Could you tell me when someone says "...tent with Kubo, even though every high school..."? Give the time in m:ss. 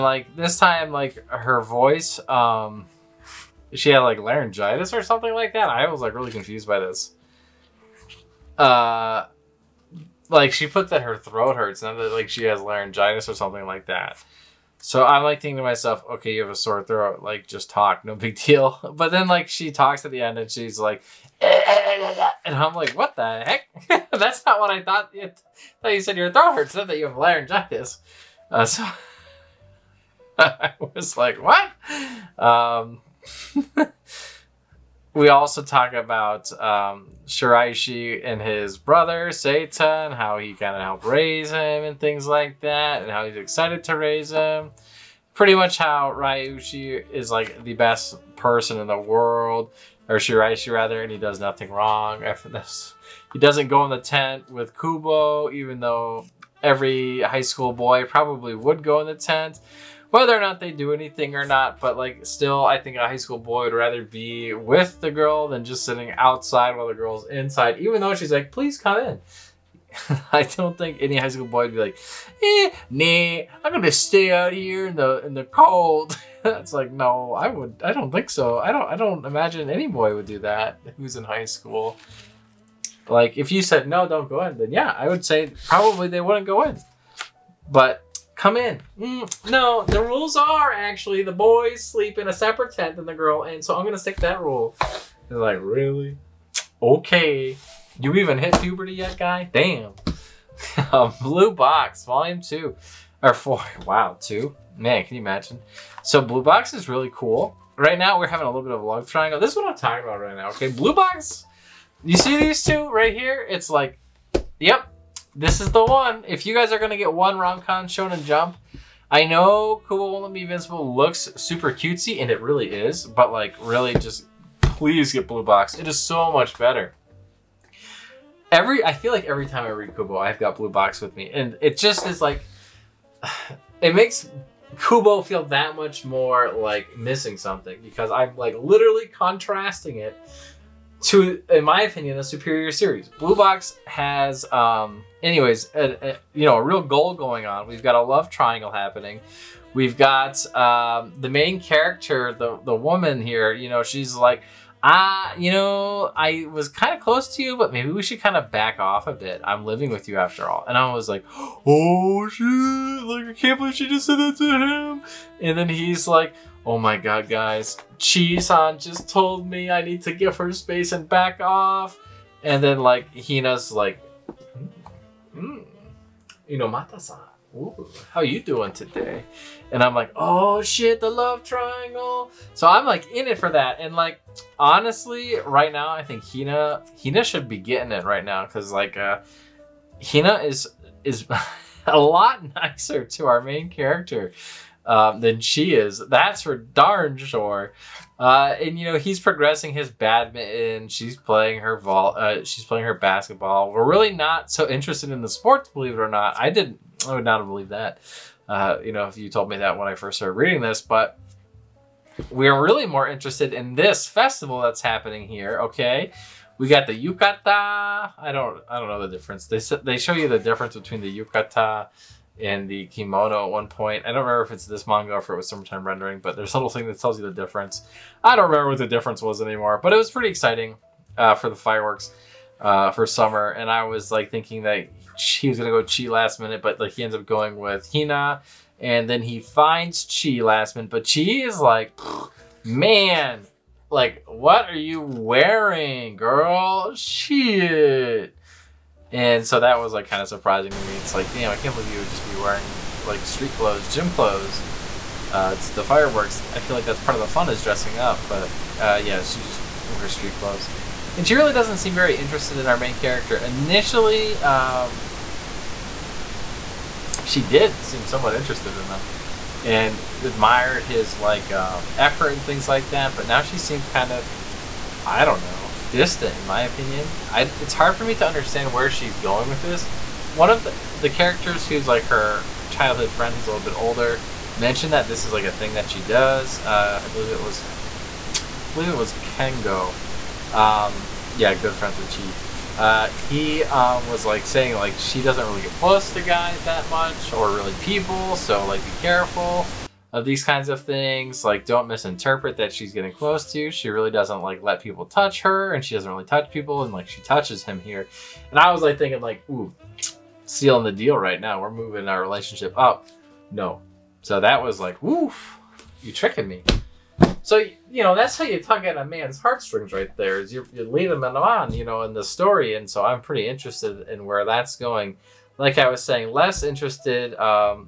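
0:53.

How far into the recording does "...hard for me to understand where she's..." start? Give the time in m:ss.
4:37.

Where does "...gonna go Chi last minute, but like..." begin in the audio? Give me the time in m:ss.
3:55.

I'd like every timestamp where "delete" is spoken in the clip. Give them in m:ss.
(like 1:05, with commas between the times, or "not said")
not said.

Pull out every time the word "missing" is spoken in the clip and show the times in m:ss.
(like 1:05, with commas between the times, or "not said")
2:16.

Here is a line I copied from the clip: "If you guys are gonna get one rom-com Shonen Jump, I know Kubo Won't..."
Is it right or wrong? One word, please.
right.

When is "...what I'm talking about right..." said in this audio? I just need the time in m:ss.
1:49.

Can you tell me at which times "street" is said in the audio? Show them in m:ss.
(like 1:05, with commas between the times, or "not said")
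4:13, 4:20.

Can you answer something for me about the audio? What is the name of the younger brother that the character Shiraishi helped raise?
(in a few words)
Seita.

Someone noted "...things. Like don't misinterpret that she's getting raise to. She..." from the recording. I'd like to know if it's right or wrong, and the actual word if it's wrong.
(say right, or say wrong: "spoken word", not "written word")
wrong: "close", not "raise".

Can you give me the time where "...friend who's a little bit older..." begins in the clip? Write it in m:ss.
4:43.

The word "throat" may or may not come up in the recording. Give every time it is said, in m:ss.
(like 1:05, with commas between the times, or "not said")
0:11, 0:16, 0:26.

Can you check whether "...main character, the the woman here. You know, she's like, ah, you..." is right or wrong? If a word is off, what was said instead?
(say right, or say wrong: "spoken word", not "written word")
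right.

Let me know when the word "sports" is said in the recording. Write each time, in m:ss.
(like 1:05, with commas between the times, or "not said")
3:25.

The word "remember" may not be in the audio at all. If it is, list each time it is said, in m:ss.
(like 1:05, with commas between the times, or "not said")
3:44, 3:48.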